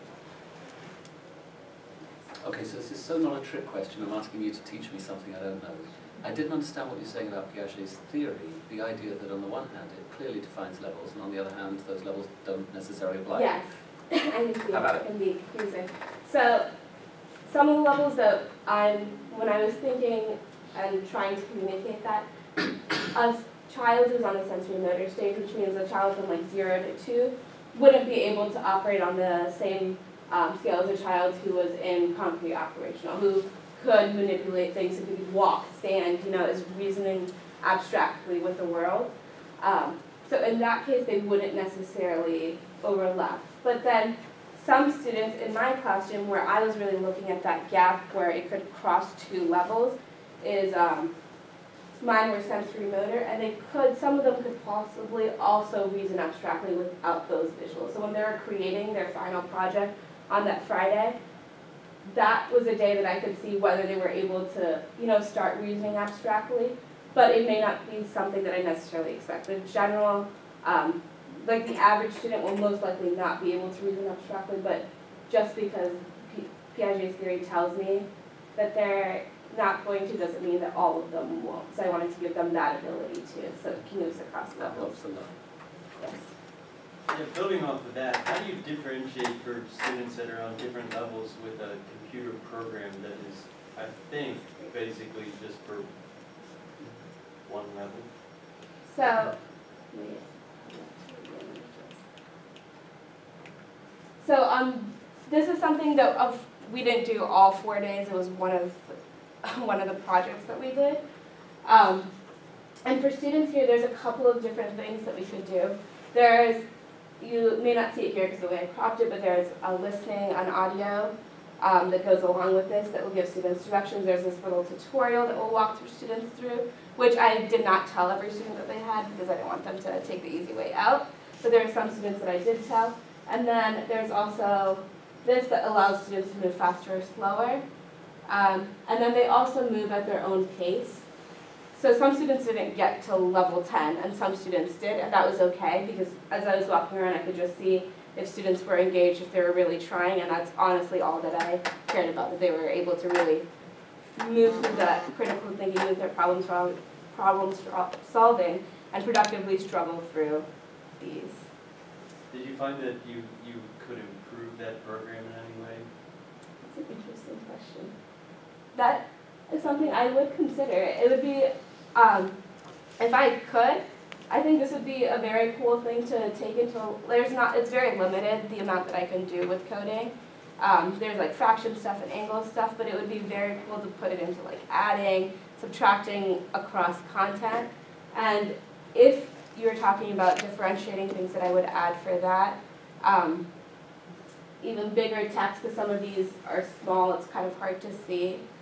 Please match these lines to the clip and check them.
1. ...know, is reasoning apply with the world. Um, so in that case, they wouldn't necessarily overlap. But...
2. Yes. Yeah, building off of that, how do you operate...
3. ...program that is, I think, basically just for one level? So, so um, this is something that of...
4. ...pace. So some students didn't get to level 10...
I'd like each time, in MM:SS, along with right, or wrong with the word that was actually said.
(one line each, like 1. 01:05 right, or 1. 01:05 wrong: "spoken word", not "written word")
1. 00:36 wrong: "abstractly", not "apply"
2. 01:26 wrong: "differentiate", not "operate"
3. 01:32 right
4. 02:20 right.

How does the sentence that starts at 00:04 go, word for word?
I'm asking you to teach me something I don't know.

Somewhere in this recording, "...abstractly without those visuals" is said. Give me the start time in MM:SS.
00:56.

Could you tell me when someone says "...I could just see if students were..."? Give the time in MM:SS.
02:27.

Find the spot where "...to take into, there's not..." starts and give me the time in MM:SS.
02:56.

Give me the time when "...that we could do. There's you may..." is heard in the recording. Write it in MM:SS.
01:55.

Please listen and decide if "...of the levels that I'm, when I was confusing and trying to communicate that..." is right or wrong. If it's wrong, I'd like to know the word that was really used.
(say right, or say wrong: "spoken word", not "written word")
wrong: "thinking", not "confusing".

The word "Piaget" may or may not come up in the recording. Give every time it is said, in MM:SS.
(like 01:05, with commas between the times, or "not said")
00:07, 01:16.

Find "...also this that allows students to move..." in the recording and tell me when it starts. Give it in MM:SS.
02:14.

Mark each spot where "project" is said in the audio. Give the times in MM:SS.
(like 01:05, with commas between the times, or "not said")
00:59, 01:49.